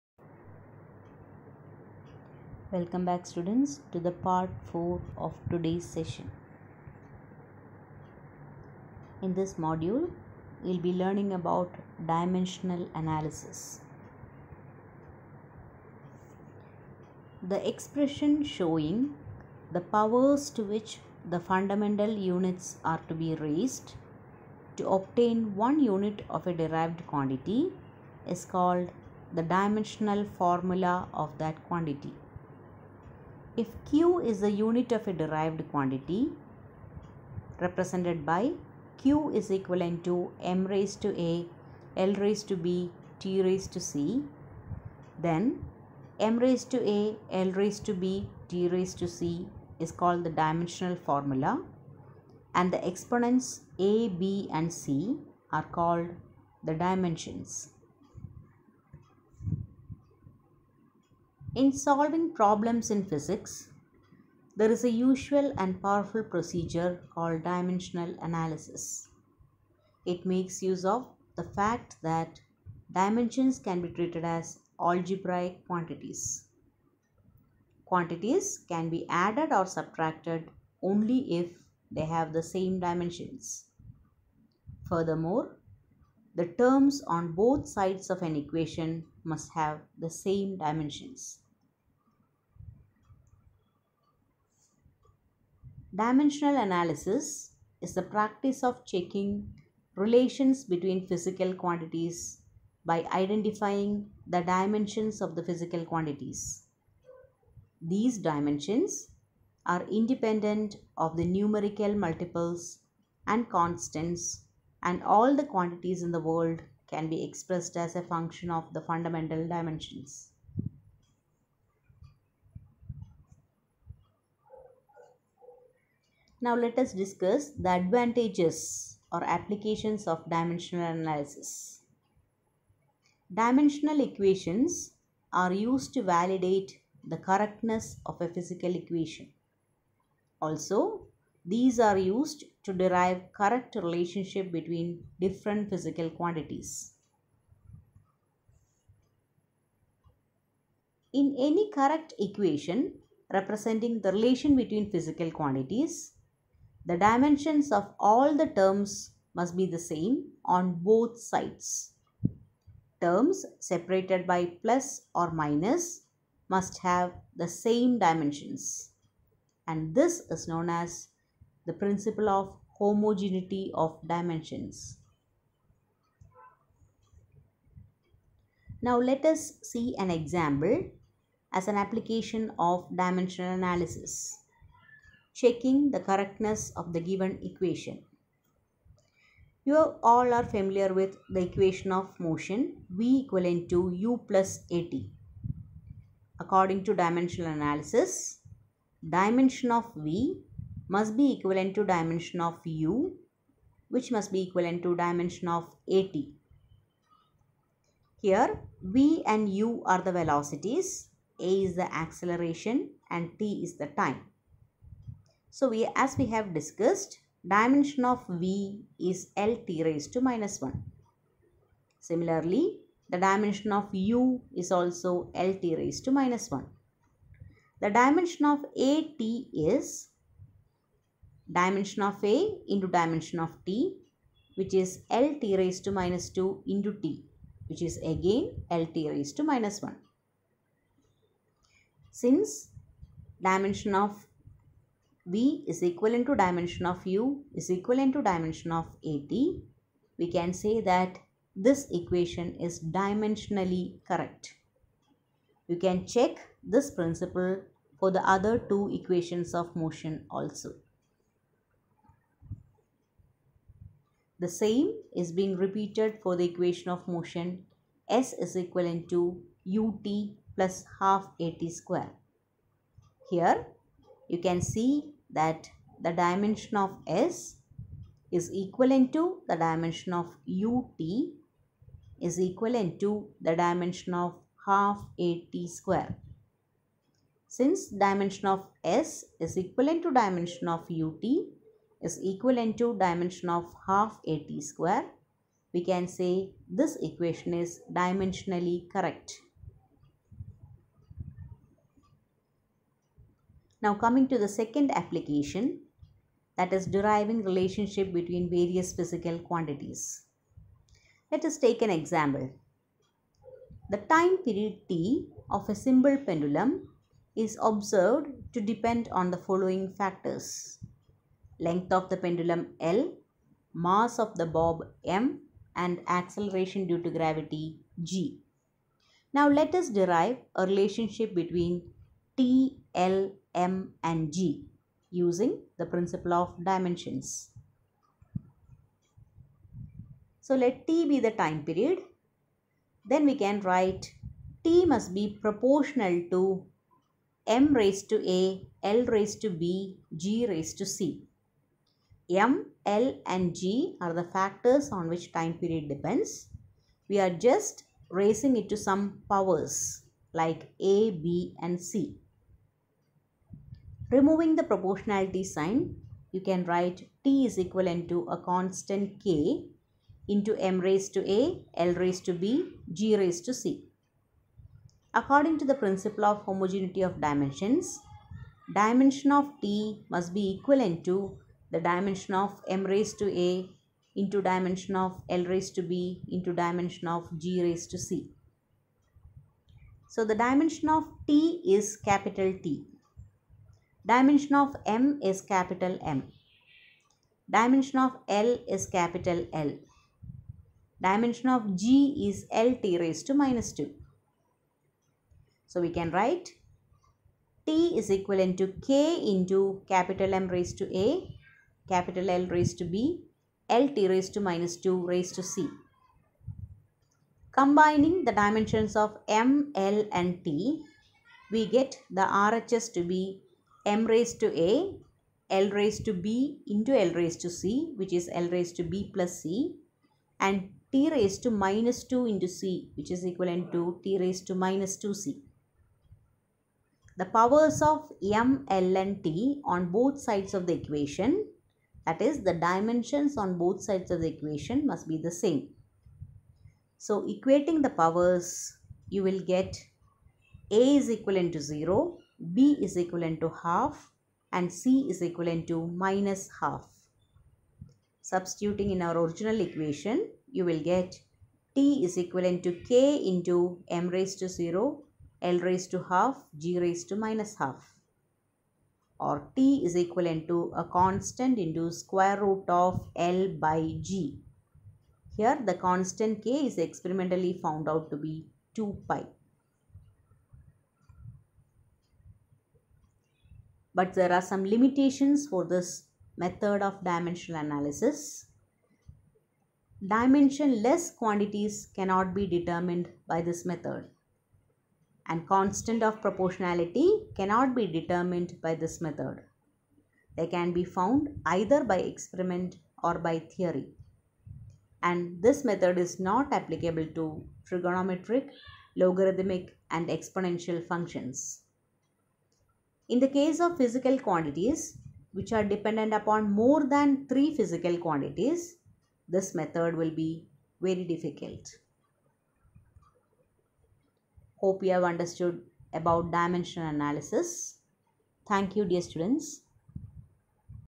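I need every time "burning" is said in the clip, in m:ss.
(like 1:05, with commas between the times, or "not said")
not said.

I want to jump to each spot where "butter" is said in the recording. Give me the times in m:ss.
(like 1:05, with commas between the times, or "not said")
not said.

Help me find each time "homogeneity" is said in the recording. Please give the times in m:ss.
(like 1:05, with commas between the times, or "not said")
2:52, 6:16.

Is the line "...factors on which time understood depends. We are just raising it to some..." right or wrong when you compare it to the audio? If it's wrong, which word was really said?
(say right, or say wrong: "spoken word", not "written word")
wrong: "period", not "understood".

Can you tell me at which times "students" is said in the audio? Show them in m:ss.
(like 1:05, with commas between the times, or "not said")
0:03, 8:49.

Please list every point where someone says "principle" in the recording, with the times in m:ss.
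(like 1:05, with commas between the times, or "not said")
2:51, 4:16, 5:35, 6:15.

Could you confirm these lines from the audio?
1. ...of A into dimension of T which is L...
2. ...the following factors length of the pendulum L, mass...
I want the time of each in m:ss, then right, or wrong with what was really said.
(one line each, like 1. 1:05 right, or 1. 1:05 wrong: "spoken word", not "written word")
1. 3:52 right
2. 5:19 right.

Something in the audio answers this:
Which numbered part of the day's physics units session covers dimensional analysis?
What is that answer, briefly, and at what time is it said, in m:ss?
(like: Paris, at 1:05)
Part 4, at 0:04.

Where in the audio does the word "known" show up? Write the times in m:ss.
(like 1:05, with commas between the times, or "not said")
2:50.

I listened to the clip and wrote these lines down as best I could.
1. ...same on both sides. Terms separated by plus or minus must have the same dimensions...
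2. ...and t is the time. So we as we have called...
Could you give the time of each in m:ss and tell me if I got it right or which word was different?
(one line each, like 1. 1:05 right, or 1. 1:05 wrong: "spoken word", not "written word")
1. 2:39 right
2. 3:33 wrong: "discussed", not "called".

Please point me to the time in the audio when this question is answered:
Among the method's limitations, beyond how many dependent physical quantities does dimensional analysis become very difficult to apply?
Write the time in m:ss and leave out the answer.
8:36.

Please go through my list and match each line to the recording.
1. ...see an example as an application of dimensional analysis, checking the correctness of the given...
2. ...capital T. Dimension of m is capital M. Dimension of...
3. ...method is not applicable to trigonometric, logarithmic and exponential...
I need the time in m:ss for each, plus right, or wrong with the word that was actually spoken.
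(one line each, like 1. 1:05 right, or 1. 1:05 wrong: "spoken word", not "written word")
1. 2:59 right
2. 6:31 right
3. 8:25 right.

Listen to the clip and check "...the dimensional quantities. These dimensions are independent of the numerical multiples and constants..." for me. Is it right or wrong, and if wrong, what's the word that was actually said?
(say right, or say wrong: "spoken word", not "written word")
wrong: "physical", not "dimensional".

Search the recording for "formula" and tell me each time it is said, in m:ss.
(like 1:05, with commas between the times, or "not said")
0:30, 0:51.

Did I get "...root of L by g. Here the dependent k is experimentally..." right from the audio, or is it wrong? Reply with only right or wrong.
wrong.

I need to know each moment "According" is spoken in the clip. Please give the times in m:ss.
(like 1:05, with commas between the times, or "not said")
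3:16, 6:15.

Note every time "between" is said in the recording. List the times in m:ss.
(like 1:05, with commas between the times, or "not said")
1:40, 2:24, 2:34, 5:08, 5:31.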